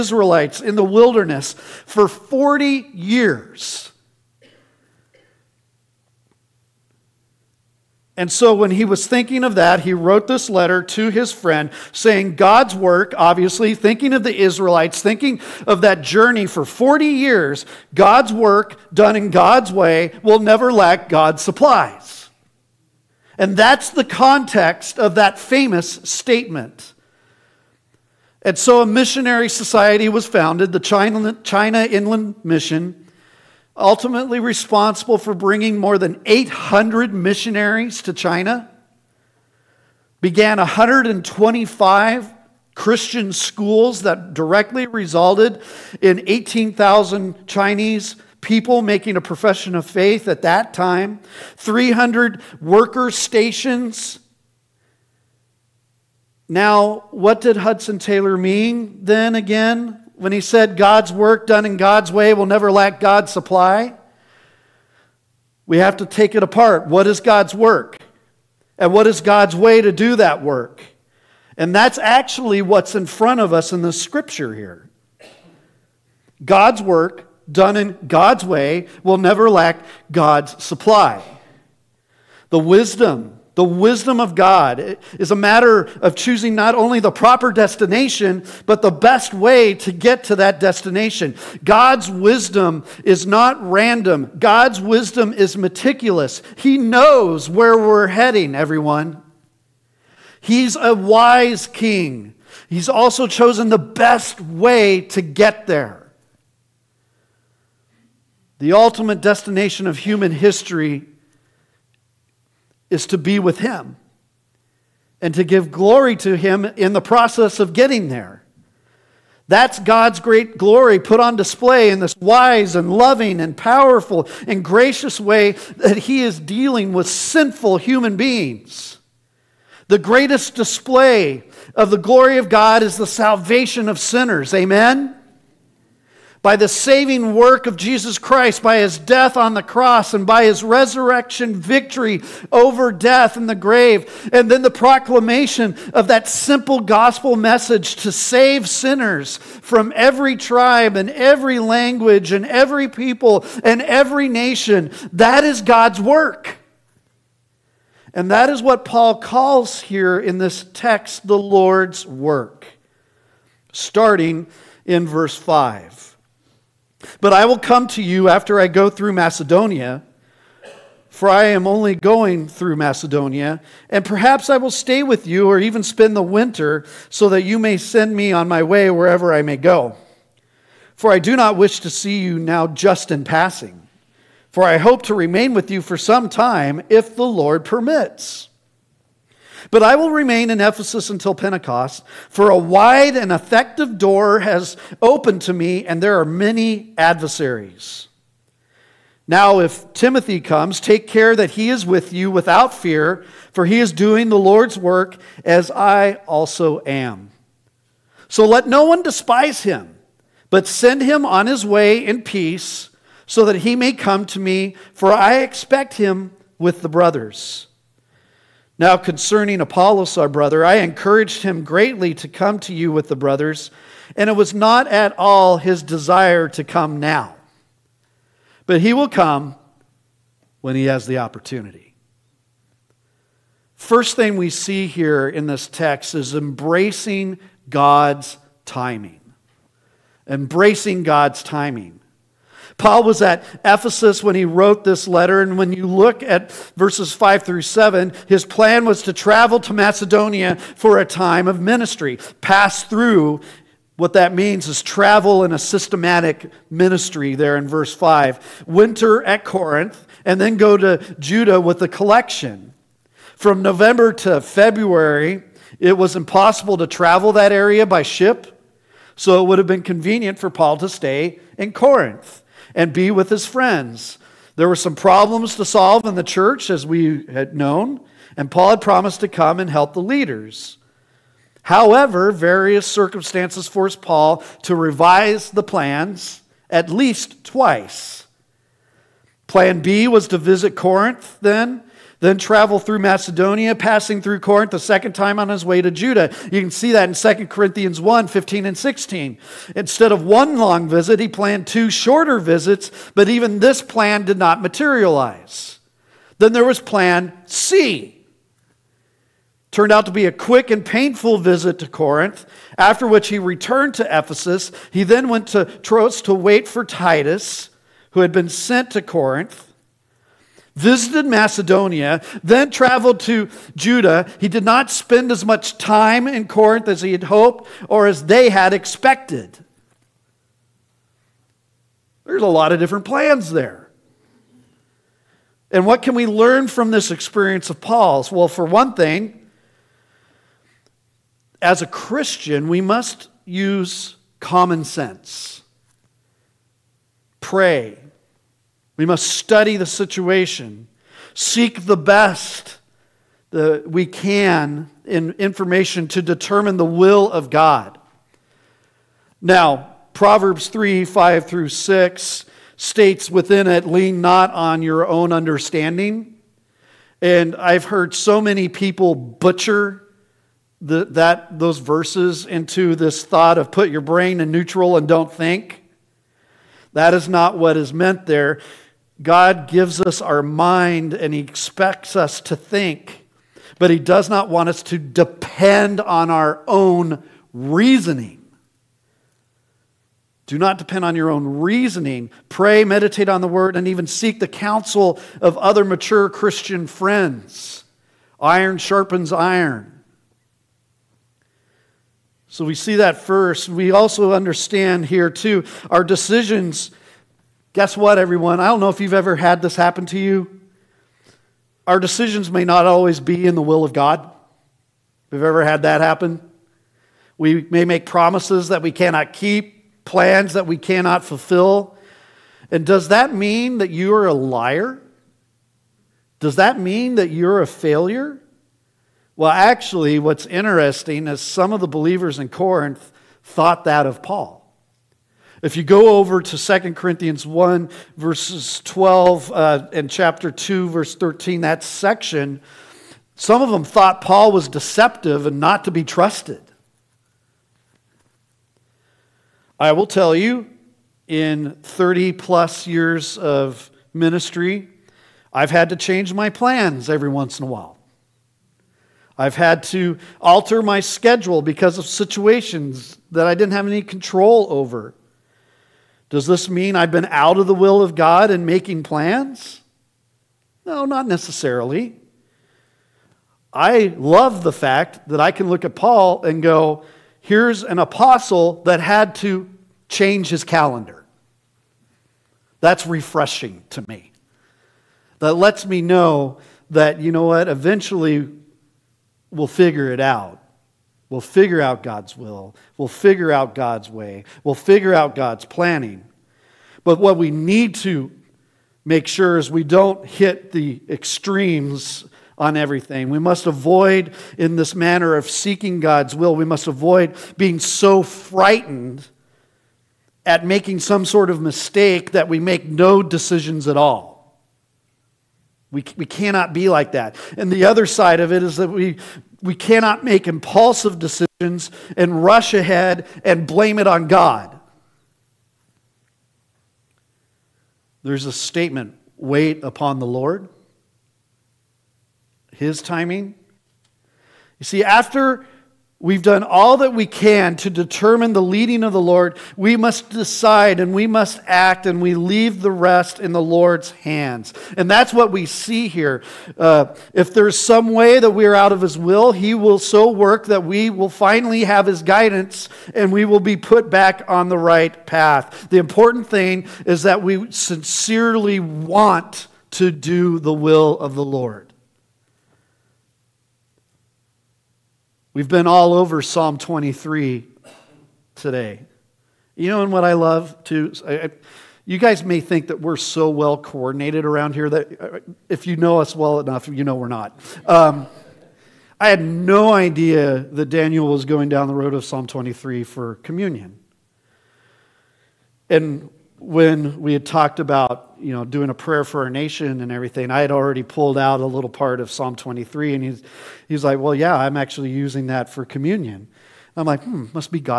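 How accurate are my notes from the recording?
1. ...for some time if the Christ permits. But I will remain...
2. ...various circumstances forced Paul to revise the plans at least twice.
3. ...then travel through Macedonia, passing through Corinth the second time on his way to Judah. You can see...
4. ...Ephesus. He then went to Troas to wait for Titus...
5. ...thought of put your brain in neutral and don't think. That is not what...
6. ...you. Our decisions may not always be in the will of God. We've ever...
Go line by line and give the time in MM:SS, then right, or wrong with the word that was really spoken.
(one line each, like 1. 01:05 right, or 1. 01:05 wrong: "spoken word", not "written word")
1. 03:05 wrong: "Lord", not "Christ"
2. 04:42 right
3. 04:52 right
4. 05:14 right
5. 06:13 right
6. 06:50 right.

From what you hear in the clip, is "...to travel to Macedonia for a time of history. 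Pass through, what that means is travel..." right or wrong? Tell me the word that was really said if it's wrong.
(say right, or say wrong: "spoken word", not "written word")
wrong: "ministry", not "history".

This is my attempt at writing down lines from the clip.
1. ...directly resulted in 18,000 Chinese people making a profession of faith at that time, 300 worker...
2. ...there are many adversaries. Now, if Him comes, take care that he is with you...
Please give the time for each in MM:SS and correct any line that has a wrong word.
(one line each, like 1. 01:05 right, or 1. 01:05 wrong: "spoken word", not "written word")
1. 00:44 right
2. 03:16 wrong: "Timothy", not "Him".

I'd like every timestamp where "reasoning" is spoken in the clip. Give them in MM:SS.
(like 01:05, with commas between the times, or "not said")
06:27, 06:31.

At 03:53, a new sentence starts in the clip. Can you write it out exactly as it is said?
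First thing we see here in this text is embracing God's timing.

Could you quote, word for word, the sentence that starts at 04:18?
Winter at Corinth, and then go to Judah with a collection.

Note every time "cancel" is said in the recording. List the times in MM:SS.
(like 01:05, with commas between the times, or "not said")
not said.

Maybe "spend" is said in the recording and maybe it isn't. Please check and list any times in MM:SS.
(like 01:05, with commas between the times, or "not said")
02:55, 05:24.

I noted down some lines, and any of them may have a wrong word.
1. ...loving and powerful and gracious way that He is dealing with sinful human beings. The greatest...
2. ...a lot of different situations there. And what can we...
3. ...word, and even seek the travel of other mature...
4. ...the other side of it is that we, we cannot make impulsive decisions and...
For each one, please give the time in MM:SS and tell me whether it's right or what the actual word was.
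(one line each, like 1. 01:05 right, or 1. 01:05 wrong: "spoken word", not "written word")
1. 02:02 right
2. 05:32 wrong: "plans", not "situations"
3. 06:33 wrong: "counsel", not "travel"
4. 08:37 right.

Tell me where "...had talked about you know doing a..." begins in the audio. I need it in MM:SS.
09:47.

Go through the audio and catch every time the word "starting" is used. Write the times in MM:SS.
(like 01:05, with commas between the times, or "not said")
02:43.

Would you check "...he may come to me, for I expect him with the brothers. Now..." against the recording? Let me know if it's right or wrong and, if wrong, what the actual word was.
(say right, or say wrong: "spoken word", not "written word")
right.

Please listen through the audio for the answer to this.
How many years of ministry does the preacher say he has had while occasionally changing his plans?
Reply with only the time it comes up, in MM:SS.
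07:31.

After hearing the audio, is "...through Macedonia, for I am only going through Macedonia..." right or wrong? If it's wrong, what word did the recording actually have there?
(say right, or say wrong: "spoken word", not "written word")
right.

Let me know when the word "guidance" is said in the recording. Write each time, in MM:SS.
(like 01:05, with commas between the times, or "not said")
09:12.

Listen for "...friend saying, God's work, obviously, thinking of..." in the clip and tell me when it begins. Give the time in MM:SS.
00:11.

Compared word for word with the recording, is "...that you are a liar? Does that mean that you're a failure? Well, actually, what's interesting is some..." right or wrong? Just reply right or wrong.
right.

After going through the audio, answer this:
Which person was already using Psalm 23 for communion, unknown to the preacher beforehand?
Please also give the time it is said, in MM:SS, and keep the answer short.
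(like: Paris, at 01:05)
Daniel, at 09:40.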